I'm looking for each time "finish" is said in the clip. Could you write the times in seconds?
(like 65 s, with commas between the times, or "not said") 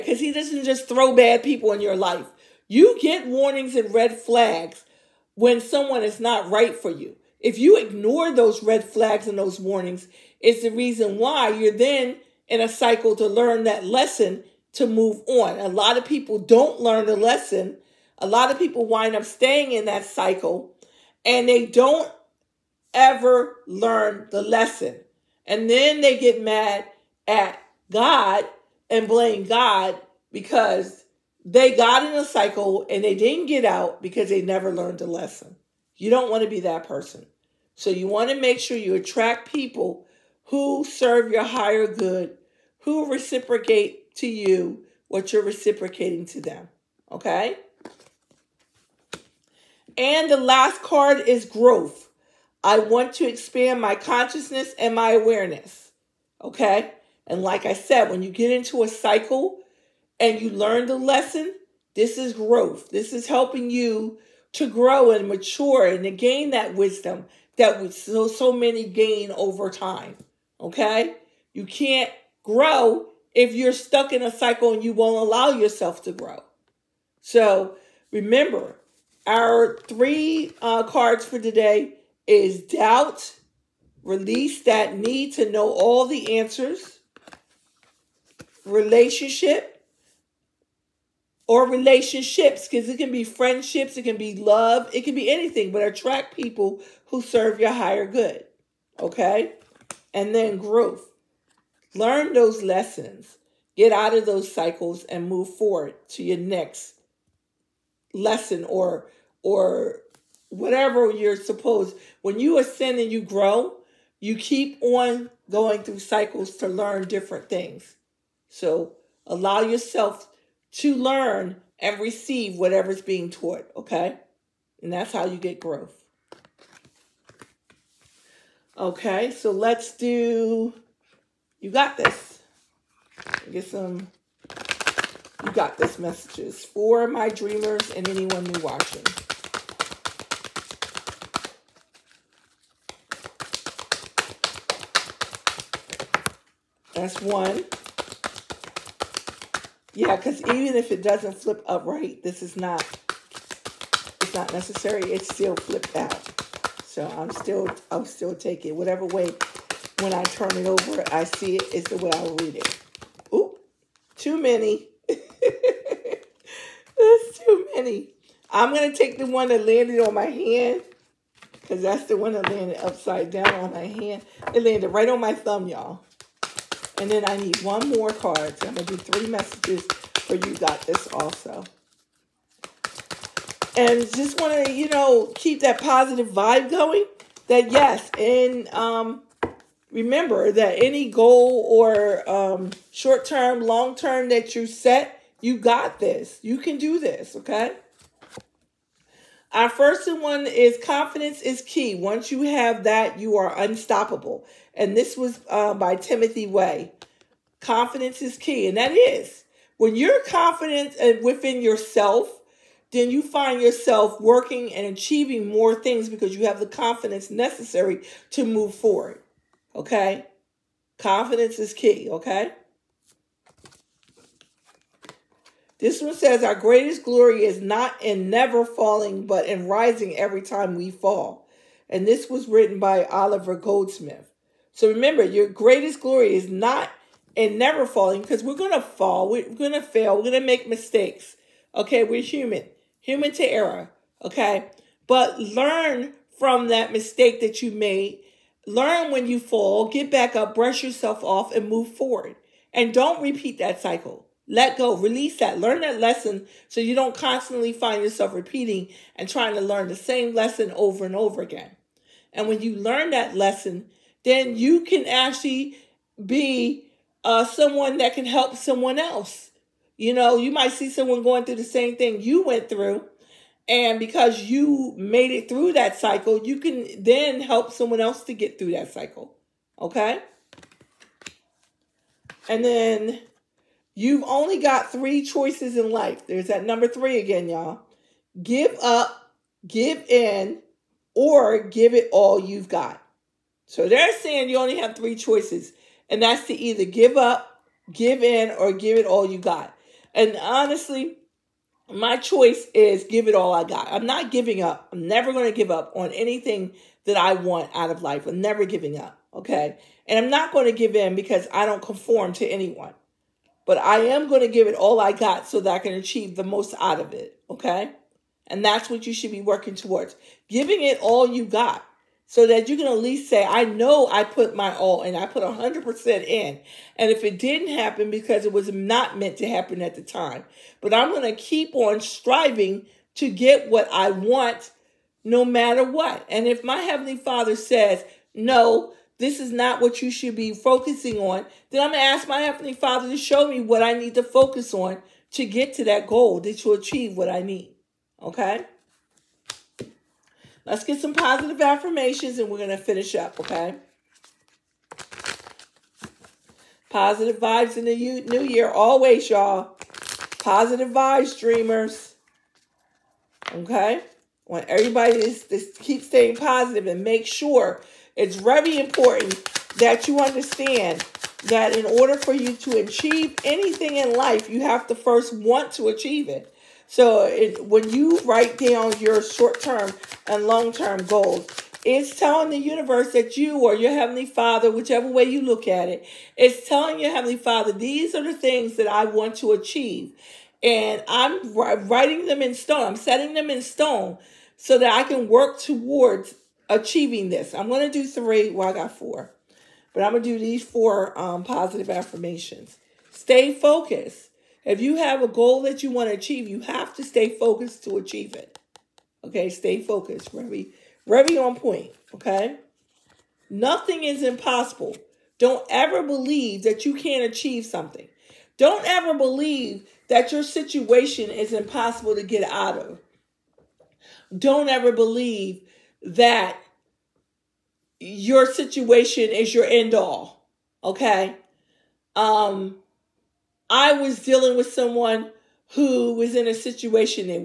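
352 s.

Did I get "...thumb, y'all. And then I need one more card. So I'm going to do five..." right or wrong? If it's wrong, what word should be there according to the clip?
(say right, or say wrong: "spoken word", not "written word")
wrong: "three", not "five".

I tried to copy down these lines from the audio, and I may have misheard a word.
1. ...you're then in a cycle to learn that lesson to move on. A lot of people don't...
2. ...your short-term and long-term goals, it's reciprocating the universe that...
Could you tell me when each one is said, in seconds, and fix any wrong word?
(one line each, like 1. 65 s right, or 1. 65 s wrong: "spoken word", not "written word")
1. 11 s right
2. 378 s wrong: "telling", not "reciprocating".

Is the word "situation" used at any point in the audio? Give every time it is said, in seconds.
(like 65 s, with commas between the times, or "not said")
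420 s, 428 s, 436 s.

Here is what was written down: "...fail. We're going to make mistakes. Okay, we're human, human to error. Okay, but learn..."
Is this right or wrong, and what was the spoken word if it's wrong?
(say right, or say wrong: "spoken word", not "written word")
right.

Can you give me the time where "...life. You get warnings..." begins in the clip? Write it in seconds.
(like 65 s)
1 s.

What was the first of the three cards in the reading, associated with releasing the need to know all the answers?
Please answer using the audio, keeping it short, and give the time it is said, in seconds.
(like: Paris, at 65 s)
Doubt, at 82 s.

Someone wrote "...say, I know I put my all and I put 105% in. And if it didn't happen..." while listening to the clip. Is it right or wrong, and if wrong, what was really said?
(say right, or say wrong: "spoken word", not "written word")
wrong: "100", not "105".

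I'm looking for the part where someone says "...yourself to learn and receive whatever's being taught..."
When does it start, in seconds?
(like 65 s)
119 s.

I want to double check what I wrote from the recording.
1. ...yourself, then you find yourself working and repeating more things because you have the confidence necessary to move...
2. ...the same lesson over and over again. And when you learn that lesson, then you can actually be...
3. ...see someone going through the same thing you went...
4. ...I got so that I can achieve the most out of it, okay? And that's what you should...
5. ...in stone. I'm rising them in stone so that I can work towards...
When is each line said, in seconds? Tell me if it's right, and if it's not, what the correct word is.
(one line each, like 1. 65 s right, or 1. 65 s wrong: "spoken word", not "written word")
1. 211 s wrong: "achieving", not "repeating"
2. 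259 s right
3. 270 s right
4. 314 s right
5. 392 s wrong: "setting", not "rising".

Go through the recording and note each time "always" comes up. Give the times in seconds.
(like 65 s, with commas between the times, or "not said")
358 s.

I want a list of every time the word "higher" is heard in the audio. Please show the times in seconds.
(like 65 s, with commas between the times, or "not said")
41 s, 97 s.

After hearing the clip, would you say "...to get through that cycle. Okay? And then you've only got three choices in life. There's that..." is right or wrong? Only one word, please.
right.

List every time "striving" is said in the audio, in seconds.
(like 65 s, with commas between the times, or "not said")
331 s.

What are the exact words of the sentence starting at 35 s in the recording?
You don't want to be that person.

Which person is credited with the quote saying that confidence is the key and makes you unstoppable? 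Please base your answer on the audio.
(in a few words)
Timothy Way.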